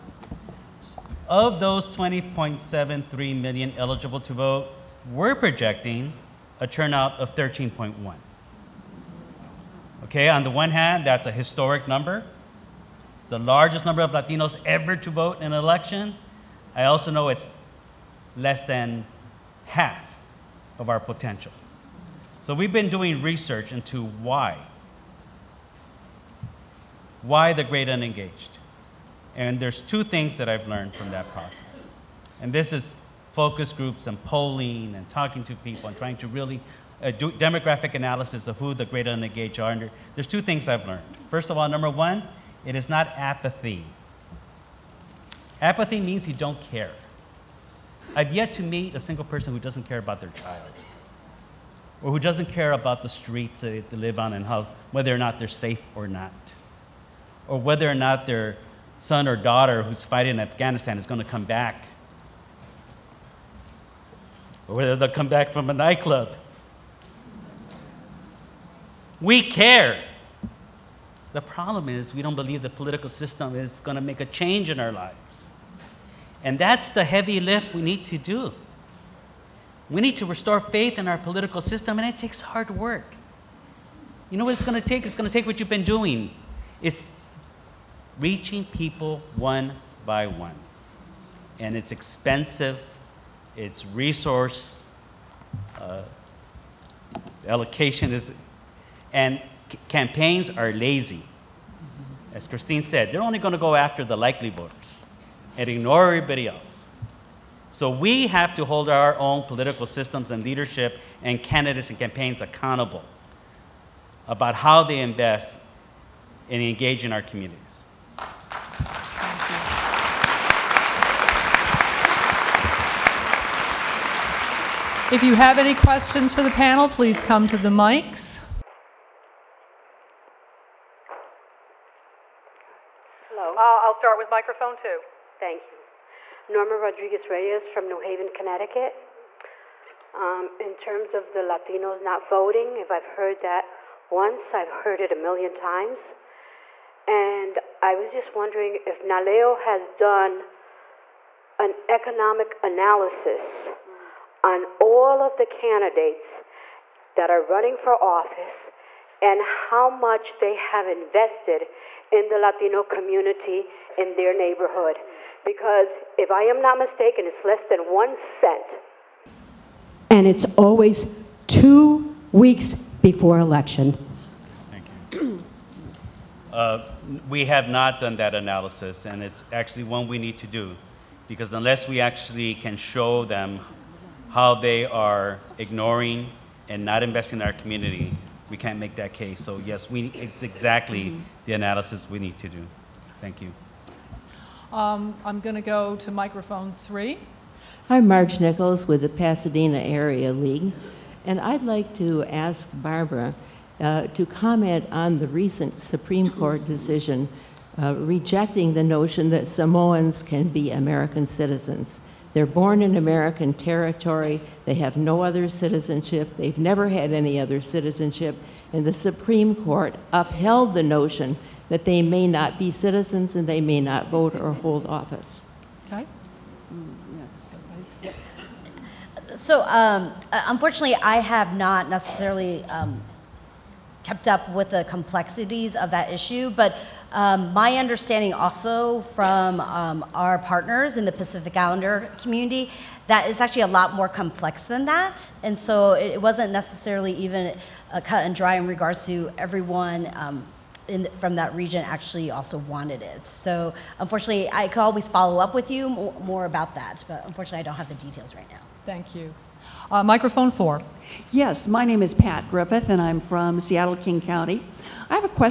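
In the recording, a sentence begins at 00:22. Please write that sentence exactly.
So we've been doing research into why.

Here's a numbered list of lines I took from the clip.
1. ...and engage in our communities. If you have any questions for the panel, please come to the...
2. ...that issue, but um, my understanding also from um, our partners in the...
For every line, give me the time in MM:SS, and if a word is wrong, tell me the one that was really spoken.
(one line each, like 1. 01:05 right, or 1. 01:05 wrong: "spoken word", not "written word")
1. 01:56 right
2. 03:55 right.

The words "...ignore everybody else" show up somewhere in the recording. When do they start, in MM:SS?
01:45.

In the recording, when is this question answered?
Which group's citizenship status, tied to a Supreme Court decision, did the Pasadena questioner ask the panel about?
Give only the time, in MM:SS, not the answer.
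03:29.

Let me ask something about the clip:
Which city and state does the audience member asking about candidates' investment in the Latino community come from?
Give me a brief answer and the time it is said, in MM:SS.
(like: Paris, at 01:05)
New Haven, Connecticut, at 02:17.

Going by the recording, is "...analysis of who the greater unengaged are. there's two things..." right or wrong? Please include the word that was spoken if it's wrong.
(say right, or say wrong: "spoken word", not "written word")
right.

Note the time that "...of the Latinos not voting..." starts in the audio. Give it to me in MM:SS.
02:21.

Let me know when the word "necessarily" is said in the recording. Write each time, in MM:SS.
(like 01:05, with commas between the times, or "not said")
03:51, 04:06.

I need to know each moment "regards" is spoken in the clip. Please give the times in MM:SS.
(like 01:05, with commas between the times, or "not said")
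04:08.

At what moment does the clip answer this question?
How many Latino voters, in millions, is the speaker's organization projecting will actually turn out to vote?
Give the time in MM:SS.
00:07.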